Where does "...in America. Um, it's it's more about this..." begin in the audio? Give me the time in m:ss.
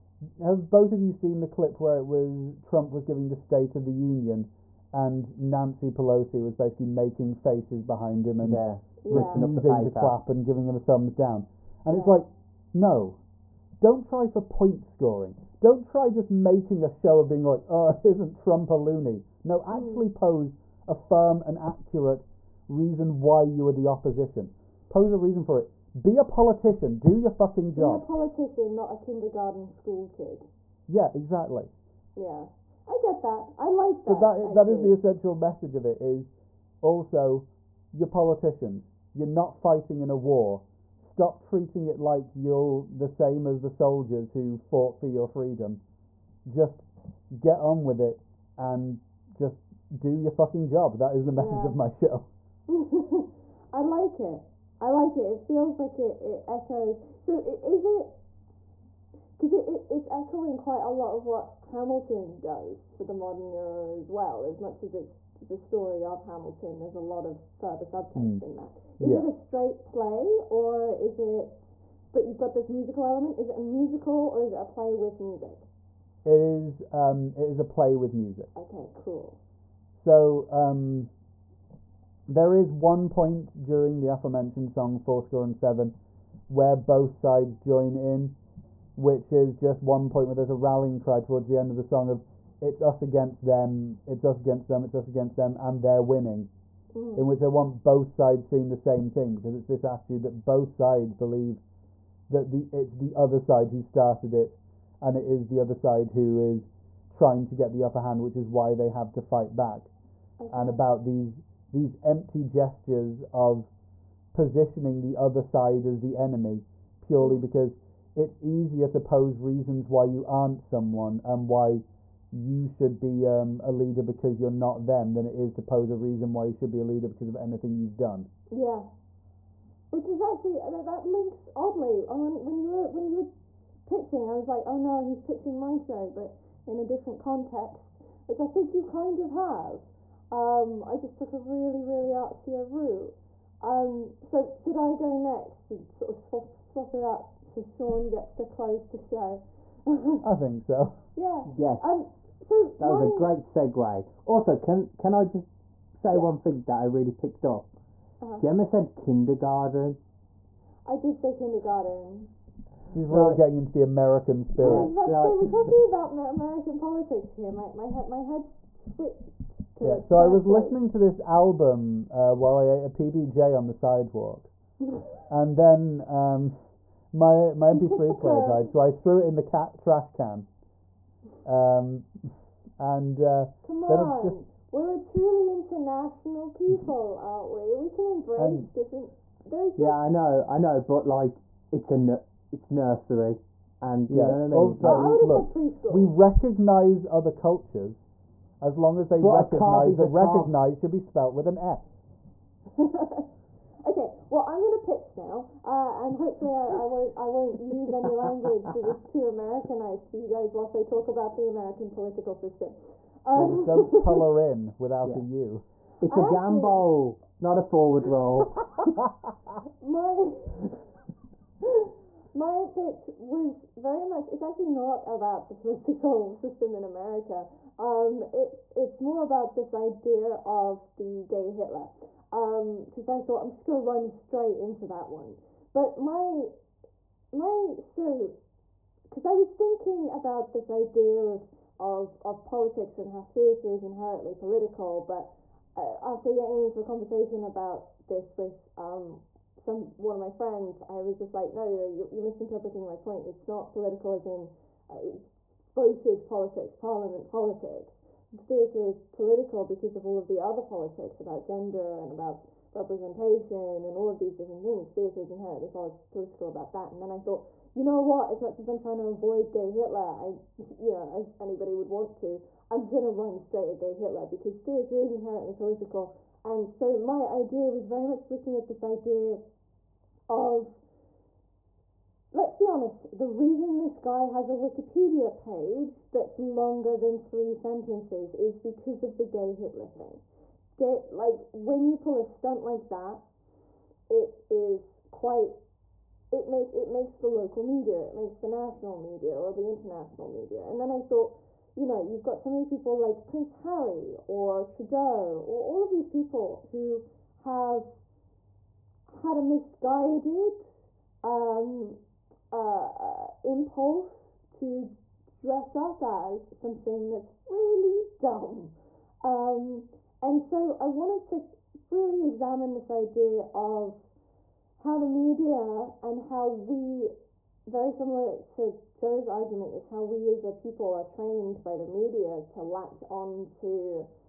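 3:46.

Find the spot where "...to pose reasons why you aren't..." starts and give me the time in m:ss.
1:58.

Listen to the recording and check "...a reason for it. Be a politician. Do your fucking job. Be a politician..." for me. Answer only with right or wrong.
right.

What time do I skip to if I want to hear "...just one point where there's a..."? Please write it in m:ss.
1:29.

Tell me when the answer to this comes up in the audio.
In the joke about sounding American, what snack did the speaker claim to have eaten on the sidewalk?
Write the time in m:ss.
2:52.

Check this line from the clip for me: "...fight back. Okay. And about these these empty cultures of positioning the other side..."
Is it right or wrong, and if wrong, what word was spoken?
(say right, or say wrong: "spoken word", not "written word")
wrong: "gestures", not "cultures".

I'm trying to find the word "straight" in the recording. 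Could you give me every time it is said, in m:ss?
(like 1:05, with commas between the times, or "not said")
1:09, 3:54, 4:33.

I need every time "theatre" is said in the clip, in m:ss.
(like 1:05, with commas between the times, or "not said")
4:03, 4:18, 4:24, 4:34.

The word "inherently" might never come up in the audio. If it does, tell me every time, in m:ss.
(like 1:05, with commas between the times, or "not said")
4:03, 4:25, 4:35.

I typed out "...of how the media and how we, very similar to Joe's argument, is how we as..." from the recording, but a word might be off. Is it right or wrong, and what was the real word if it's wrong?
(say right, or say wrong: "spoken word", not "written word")
right.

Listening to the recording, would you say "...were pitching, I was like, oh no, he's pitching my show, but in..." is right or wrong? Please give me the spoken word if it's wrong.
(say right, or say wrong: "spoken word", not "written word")
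right.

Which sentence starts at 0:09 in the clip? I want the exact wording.
refusing to clap and giving him a thumbs down.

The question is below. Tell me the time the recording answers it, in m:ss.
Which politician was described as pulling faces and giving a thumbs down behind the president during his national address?
0:05.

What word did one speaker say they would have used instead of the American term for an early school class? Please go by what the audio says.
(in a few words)
preschool.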